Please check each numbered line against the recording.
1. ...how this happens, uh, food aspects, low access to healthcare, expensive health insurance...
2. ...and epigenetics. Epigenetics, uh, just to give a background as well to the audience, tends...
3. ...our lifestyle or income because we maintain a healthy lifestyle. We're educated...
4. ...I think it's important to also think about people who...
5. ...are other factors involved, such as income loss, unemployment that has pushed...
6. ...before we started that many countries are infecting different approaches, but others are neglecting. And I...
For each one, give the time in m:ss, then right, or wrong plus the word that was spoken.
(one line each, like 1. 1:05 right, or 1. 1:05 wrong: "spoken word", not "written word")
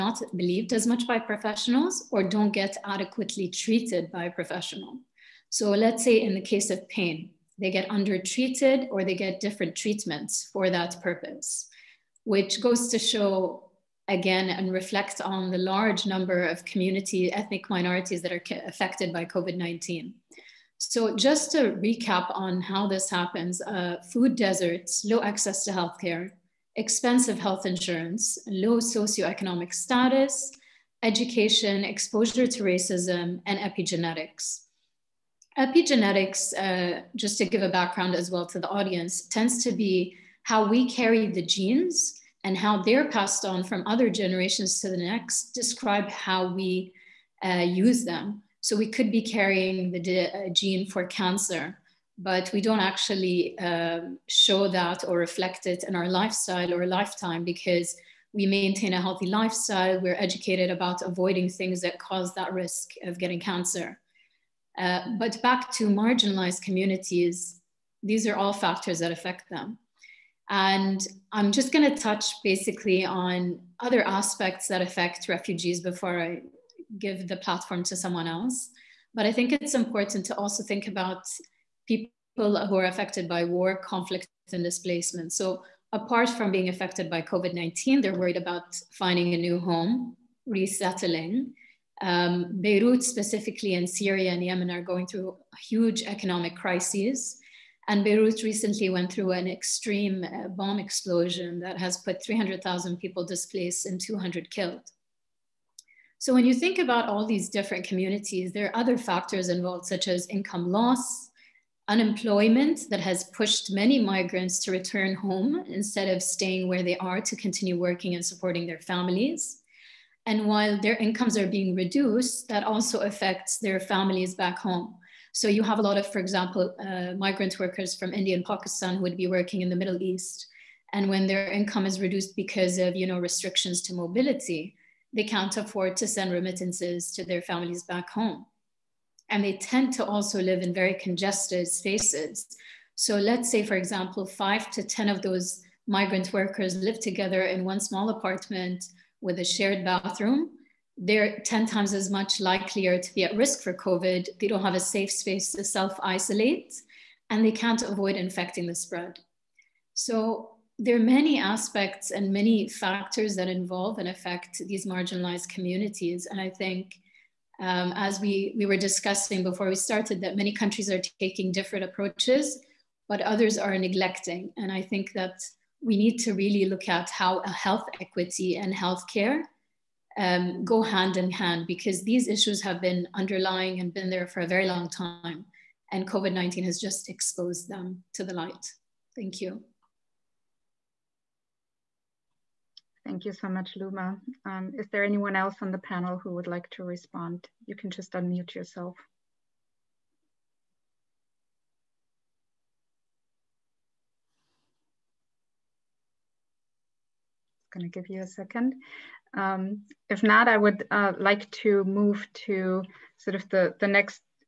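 1. 0:22 wrong: "deserts", not "aspects"
2. 0:33 right
3. 0:55 wrong: "lifetime", not "income"
4. 1:19 right
5. 1:48 right
6. 2:49 wrong: "taking", not "infecting".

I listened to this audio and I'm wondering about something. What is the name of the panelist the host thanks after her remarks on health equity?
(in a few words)
Luma.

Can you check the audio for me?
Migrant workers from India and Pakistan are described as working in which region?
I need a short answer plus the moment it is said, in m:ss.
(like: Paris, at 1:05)
the Middle East, at 2:09.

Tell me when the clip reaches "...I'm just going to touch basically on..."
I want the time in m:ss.
1:11.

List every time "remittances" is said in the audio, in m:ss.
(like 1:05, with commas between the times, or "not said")
2:16.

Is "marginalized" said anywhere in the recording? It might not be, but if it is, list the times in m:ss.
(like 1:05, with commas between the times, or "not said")
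1:05, 2:44.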